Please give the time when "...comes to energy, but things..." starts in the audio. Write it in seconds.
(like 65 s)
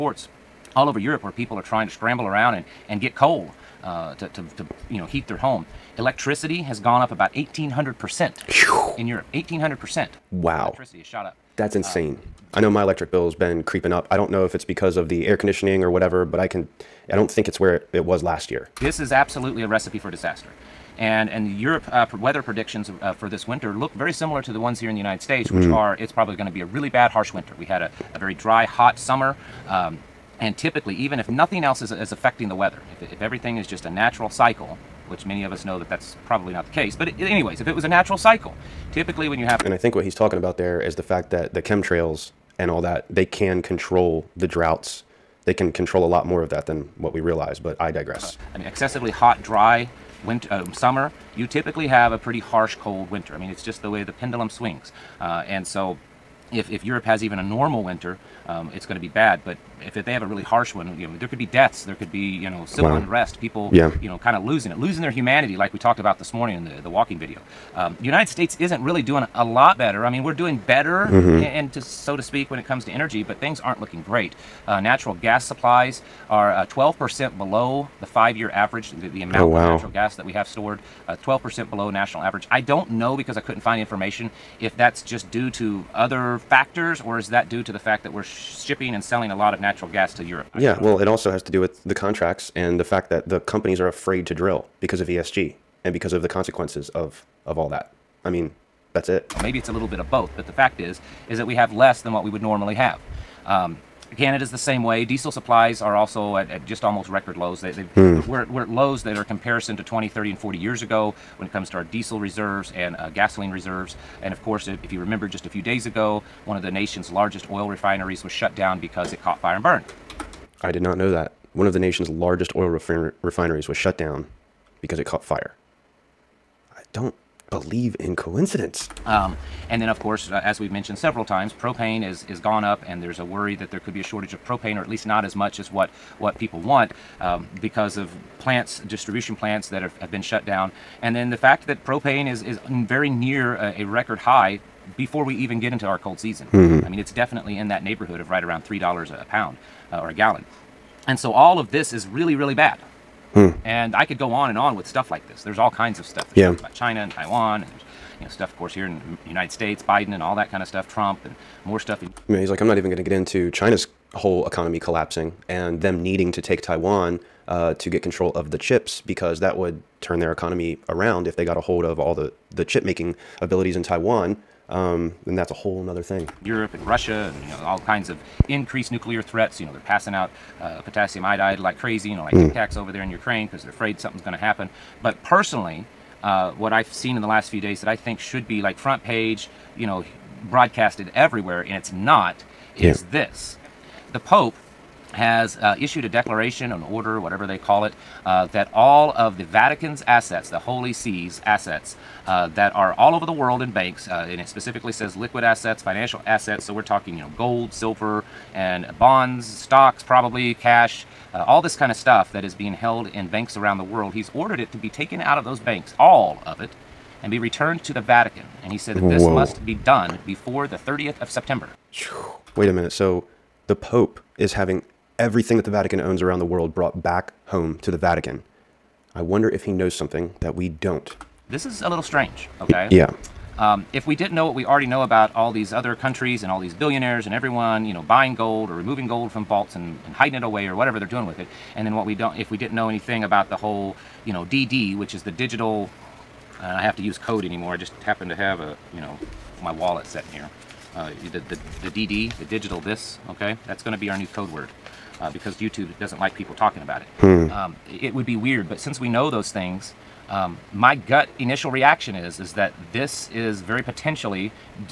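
72 s.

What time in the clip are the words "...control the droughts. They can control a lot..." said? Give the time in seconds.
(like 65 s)
43 s.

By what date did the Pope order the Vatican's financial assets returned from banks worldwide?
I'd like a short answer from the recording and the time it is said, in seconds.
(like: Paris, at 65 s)
September 30, at 220 s.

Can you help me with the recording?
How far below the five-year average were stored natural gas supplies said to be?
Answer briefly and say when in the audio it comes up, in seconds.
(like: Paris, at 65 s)
12%, at 76 s.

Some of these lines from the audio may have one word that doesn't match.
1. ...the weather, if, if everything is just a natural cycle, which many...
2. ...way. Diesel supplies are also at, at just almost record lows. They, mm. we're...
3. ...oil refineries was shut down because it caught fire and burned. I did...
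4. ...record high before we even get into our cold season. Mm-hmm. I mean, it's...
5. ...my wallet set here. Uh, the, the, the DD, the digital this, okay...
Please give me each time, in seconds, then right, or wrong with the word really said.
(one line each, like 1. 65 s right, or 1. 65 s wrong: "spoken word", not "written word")
1. 32 s right
2. 104 s right
3. 117 s right
4. 143 s right
5. 249 s right.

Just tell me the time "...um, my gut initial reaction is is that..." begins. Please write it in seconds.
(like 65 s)
260 s.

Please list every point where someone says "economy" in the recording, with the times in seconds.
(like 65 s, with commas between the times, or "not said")
164 s, 170 s.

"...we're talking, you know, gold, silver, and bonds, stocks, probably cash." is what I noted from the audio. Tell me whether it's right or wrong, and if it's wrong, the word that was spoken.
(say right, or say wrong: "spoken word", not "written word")
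right.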